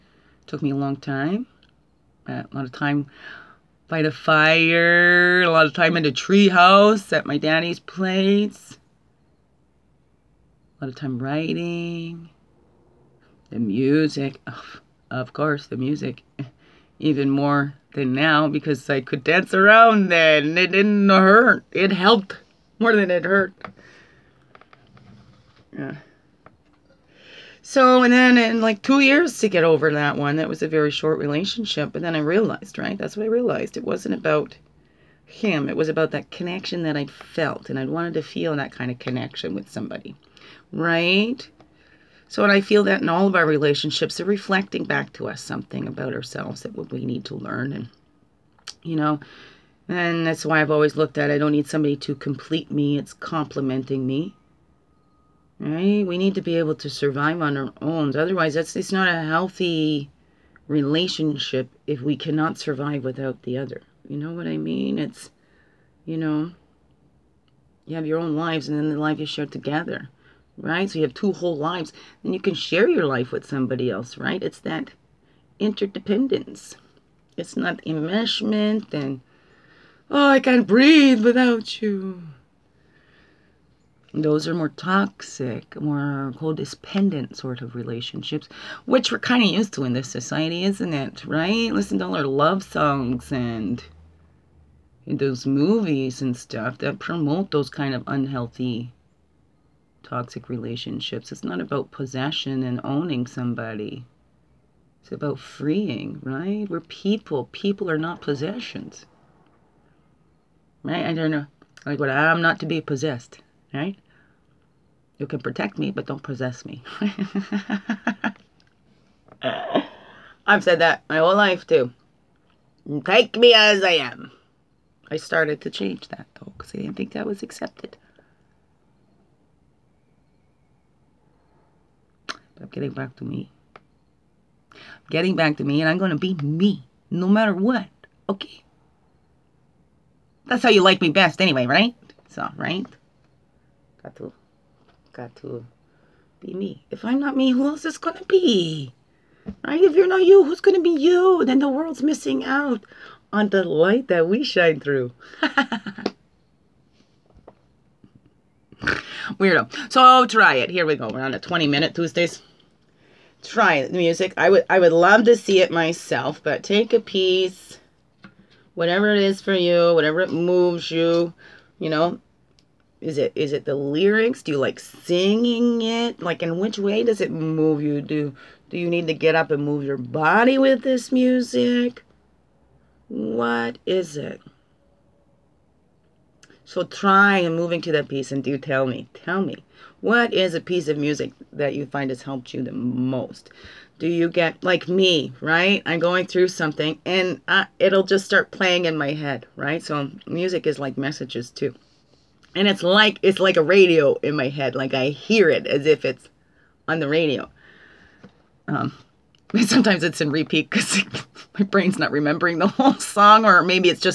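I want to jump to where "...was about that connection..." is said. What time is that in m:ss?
0:35.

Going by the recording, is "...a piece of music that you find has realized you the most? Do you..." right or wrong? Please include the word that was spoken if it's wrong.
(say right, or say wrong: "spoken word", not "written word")
wrong: "helped", not "realized".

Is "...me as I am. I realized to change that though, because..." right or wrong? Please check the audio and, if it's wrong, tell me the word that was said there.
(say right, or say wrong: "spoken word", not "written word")
wrong: "started", not "realized".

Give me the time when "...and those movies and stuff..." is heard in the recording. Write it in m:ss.
1:33.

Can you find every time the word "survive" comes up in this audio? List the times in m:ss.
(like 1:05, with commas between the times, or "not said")
0:56, 1:02.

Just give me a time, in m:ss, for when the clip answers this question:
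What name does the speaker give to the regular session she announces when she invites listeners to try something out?
2:41.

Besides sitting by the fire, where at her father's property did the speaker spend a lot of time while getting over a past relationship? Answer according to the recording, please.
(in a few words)
treehouse.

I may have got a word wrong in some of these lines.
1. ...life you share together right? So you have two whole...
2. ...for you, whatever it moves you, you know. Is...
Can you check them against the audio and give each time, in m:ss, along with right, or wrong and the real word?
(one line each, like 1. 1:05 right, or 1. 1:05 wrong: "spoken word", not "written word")
1. 1:08 right
2. 2:49 right.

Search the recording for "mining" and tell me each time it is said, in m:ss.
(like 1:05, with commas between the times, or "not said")
not said.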